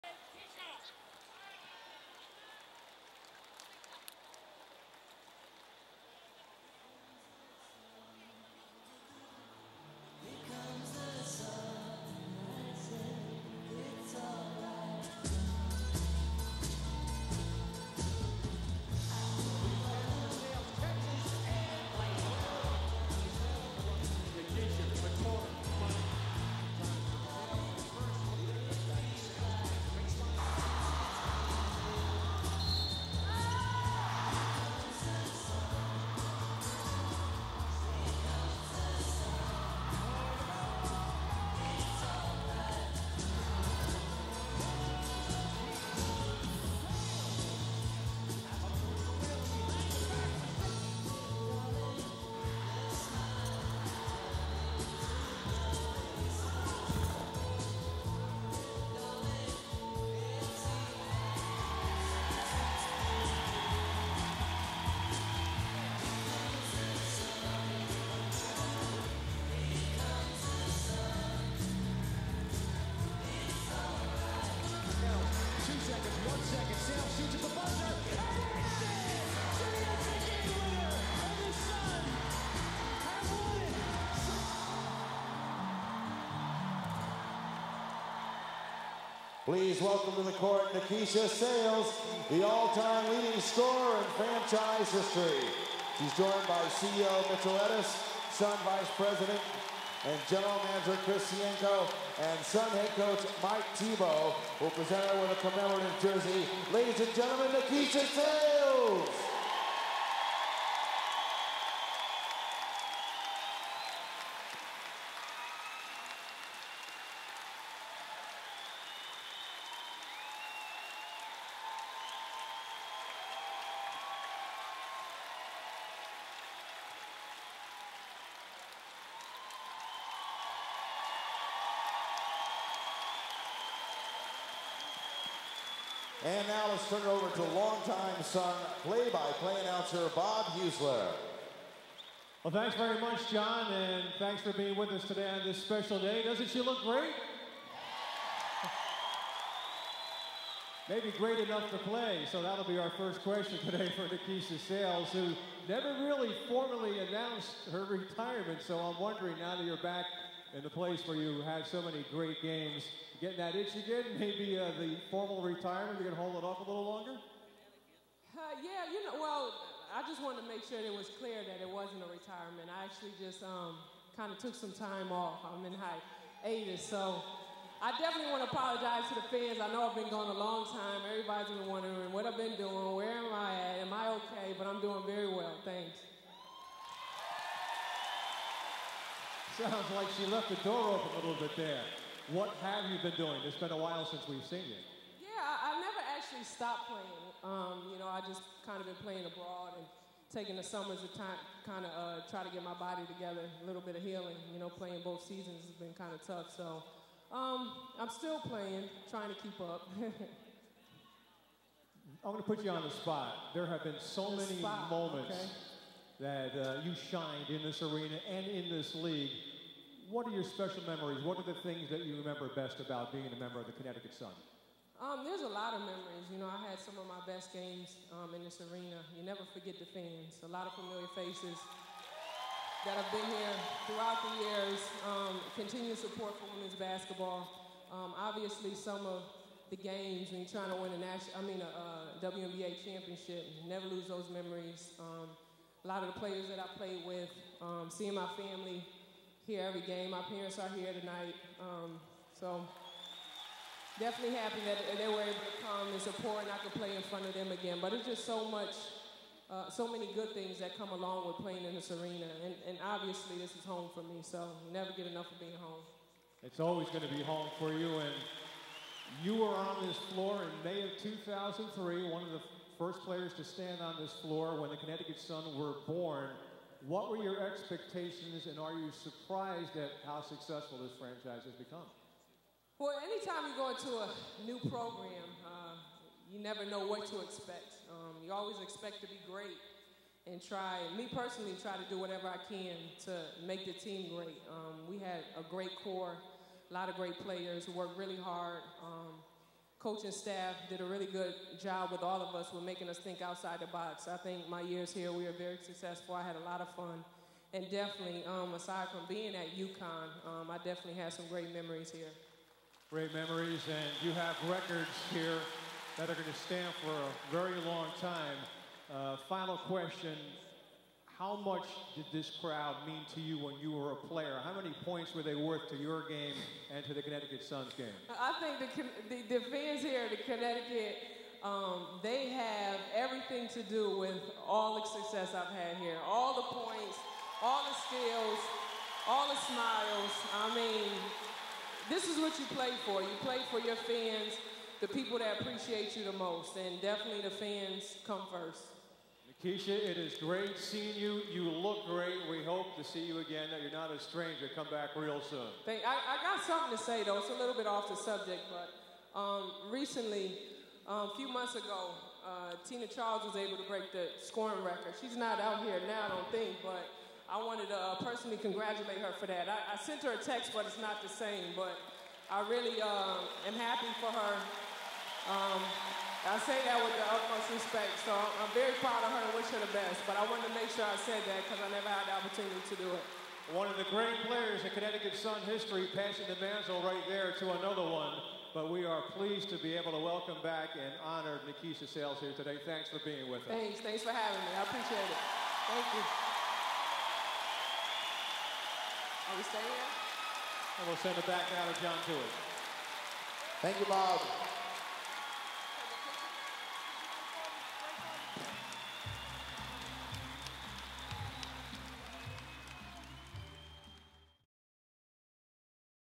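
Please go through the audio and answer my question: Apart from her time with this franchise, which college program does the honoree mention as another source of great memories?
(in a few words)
UConn.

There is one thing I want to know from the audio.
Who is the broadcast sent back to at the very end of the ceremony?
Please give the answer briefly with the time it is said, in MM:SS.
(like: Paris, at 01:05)
John Tewitt, at 06:41.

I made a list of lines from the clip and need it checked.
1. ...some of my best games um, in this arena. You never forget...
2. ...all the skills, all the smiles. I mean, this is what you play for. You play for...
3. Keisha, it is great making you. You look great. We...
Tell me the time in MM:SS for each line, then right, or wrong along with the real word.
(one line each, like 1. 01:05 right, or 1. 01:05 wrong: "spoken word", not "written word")
1. 03:46 right
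2. 05:37 right
3. 05:49 wrong: "seeing", not "making".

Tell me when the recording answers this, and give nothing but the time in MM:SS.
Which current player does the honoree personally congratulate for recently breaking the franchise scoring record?
06:02.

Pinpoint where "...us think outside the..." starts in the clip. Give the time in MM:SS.
05:02.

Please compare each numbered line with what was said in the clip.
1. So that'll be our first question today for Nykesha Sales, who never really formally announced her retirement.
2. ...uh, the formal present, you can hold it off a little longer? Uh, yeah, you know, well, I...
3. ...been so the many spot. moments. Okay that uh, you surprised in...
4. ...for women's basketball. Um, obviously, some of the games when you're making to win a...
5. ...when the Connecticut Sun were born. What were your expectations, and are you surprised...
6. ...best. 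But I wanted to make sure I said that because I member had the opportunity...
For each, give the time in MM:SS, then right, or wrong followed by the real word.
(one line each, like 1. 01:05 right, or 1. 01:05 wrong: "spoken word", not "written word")
1. 02:32 right
2. 02:44 wrong: "retirement", not "present"
3. 03:33 wrong: "shined", not "surprised"
4. 03:56 wrong: "trying", not "making"
5. 04:34 right
6. 06:19 wrong: "never", not "member".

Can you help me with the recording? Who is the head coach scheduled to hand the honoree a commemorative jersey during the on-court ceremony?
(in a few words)
Mike Thibault.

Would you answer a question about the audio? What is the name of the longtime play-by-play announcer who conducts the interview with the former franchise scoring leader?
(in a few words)
Bob Heussler.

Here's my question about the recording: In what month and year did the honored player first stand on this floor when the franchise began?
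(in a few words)
May 2003.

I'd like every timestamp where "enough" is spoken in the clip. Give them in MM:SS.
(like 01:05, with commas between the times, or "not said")
02:31, 04:25.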